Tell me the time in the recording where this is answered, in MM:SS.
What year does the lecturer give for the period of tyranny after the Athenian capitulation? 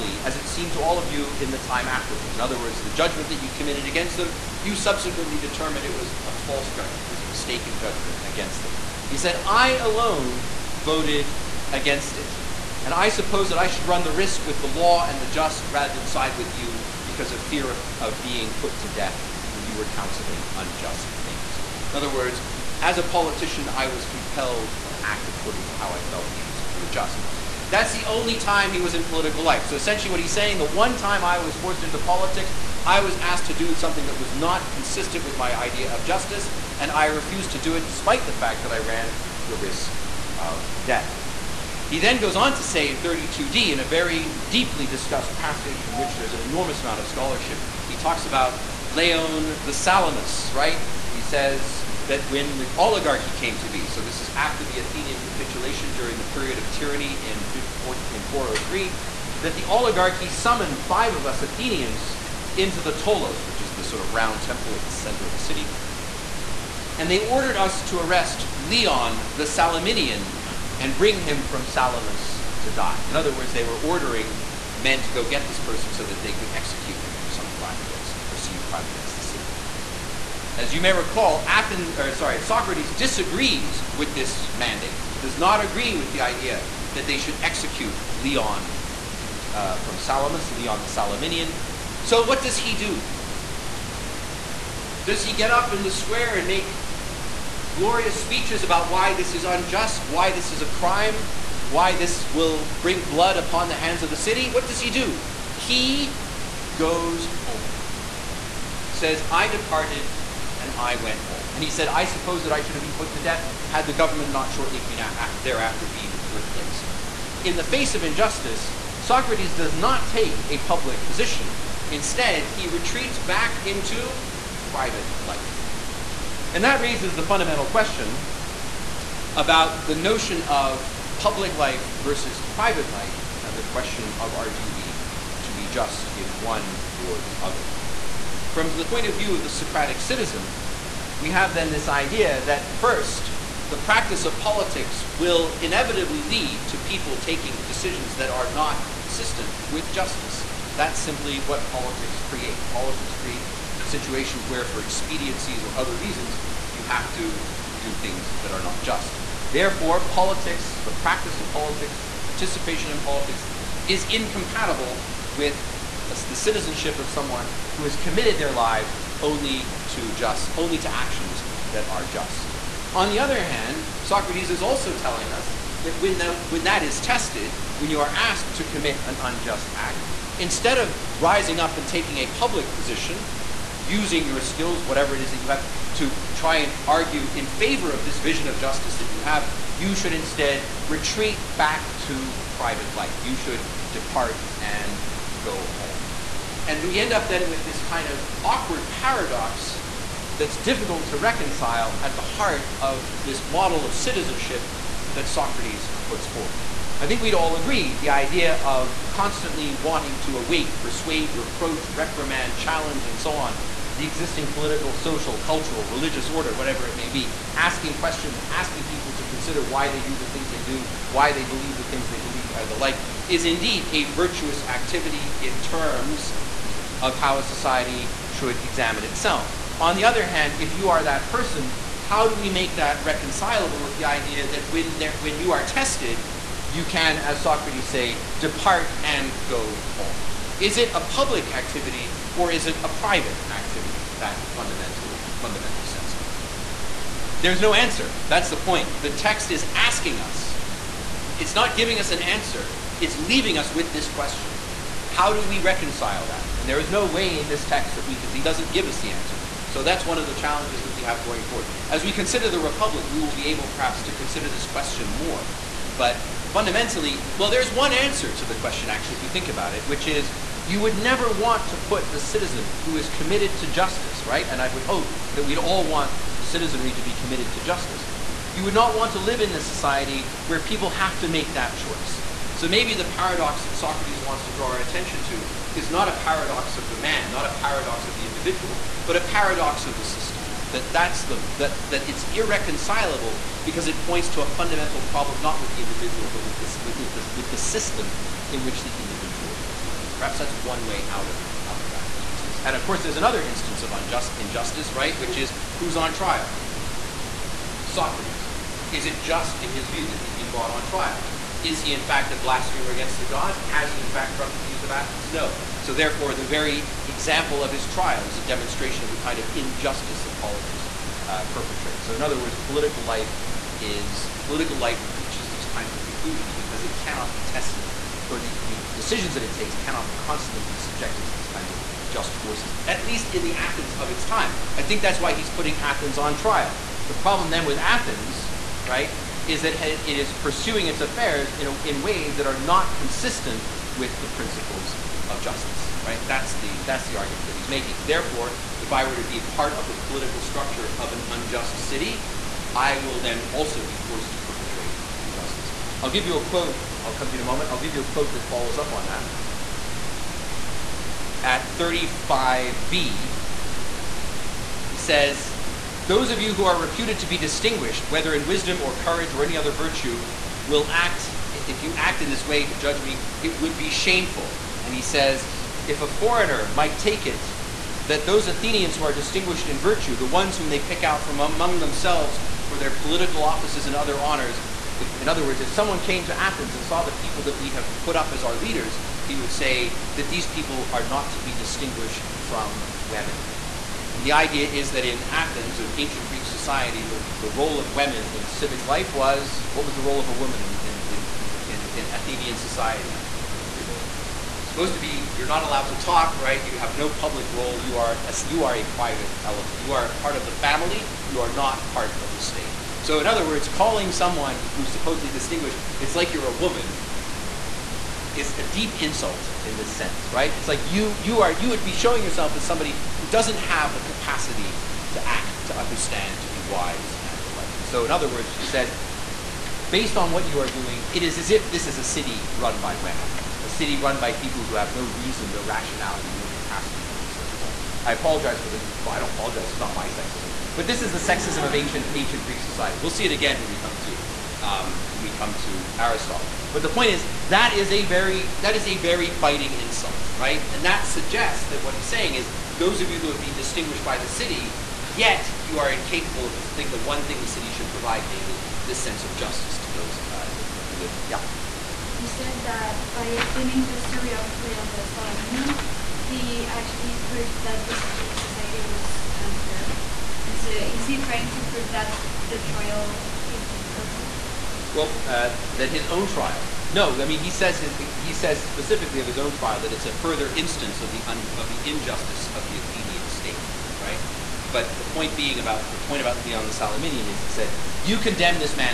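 00:57.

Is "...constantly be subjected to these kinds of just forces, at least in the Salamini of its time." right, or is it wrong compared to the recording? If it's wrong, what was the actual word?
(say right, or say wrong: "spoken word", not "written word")
wrong: "Athens", not "Salamini".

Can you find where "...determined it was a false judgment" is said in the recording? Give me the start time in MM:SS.
00:05.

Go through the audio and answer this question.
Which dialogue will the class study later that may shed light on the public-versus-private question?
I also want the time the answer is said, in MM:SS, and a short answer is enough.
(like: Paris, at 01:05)
Republic, at 04:22.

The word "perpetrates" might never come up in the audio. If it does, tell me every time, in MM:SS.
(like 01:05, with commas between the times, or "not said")
05:21, 05:54.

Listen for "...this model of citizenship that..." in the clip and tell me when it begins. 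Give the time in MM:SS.
03:23.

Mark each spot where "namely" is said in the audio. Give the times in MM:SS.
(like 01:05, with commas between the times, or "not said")
07:38.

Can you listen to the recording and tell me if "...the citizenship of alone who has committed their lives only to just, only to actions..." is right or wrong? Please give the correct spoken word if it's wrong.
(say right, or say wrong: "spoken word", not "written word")
wrong: "someone", not "alone".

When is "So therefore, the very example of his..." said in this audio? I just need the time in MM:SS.
05:15.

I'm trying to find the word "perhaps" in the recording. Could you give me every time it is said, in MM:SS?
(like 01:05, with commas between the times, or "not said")
04:23, 05:00.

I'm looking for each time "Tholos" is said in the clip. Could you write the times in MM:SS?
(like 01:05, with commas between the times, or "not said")
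01:02.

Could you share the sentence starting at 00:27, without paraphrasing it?
That's the only time he was in political life.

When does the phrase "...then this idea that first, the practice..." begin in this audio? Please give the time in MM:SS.
02:21.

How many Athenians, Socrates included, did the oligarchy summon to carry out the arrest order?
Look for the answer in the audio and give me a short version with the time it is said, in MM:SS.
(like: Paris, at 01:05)
5, at 01:00.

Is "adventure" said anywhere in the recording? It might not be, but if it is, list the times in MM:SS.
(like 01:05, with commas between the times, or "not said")
not said.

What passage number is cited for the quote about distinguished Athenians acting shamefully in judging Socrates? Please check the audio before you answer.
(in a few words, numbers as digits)
35b.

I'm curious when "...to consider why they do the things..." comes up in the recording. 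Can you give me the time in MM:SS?
03:39.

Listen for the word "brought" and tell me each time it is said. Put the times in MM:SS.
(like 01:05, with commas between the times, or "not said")
05:10.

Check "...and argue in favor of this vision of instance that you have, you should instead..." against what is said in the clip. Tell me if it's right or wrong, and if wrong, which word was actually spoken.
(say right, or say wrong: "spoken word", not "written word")
wrong: "justice", not "instance".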